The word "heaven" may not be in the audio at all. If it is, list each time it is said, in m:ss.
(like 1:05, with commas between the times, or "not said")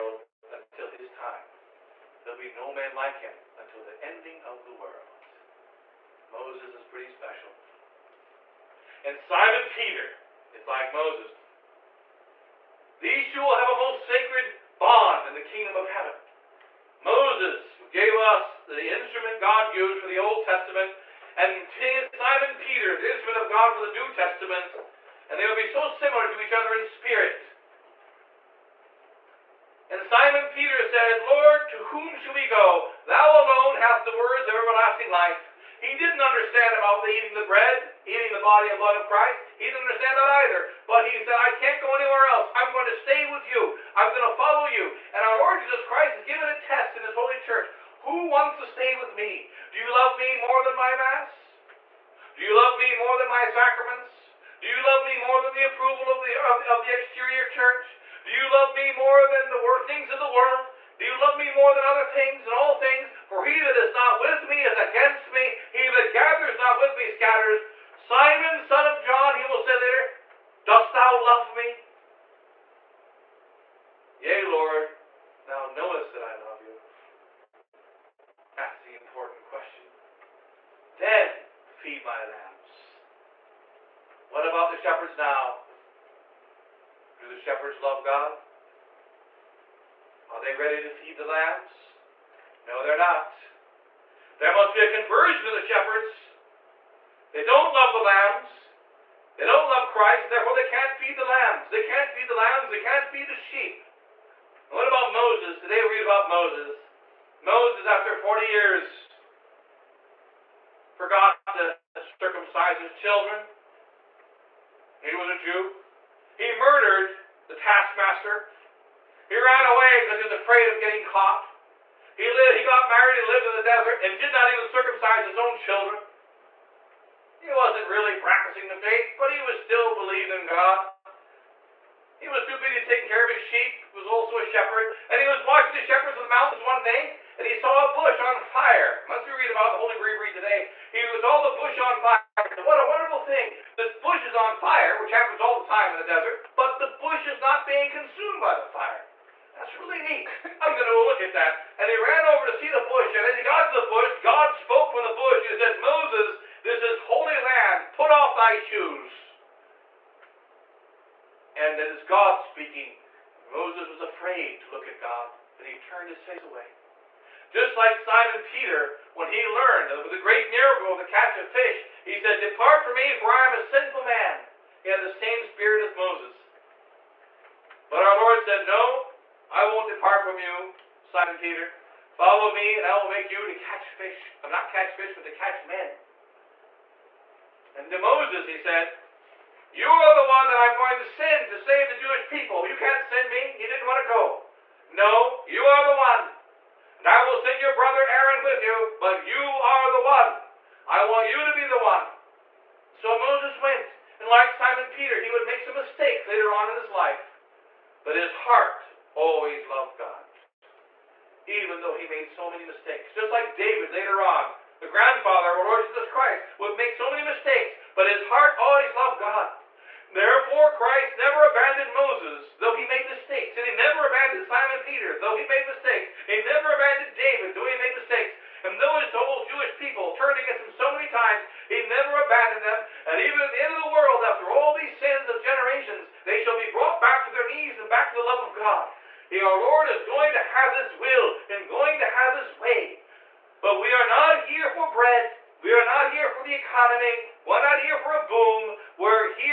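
0:15.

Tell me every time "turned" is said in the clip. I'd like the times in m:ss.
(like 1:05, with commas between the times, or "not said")
2:45, 3:50.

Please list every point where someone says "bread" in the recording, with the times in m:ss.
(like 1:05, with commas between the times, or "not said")
0:37, 4:04.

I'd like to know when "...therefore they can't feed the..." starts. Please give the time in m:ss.
1:40.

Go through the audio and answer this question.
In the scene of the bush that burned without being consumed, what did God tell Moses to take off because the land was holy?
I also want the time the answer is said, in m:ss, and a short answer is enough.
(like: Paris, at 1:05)
shoes, at 2:38.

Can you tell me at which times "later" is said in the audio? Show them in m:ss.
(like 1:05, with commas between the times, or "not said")
1:09, 3:26, 3:33.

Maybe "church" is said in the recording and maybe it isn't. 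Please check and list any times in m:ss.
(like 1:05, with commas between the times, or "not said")
0:47, 0:57.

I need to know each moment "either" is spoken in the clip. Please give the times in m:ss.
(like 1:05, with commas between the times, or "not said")
0:40.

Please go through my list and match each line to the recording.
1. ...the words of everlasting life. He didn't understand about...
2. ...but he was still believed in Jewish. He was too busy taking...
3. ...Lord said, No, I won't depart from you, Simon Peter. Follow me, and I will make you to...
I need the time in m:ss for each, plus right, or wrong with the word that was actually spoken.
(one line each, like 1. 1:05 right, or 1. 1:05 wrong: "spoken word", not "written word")
1. 0:34 right
2. 2:09 wrong: "God", not "Jewish"
3. 2:58 right.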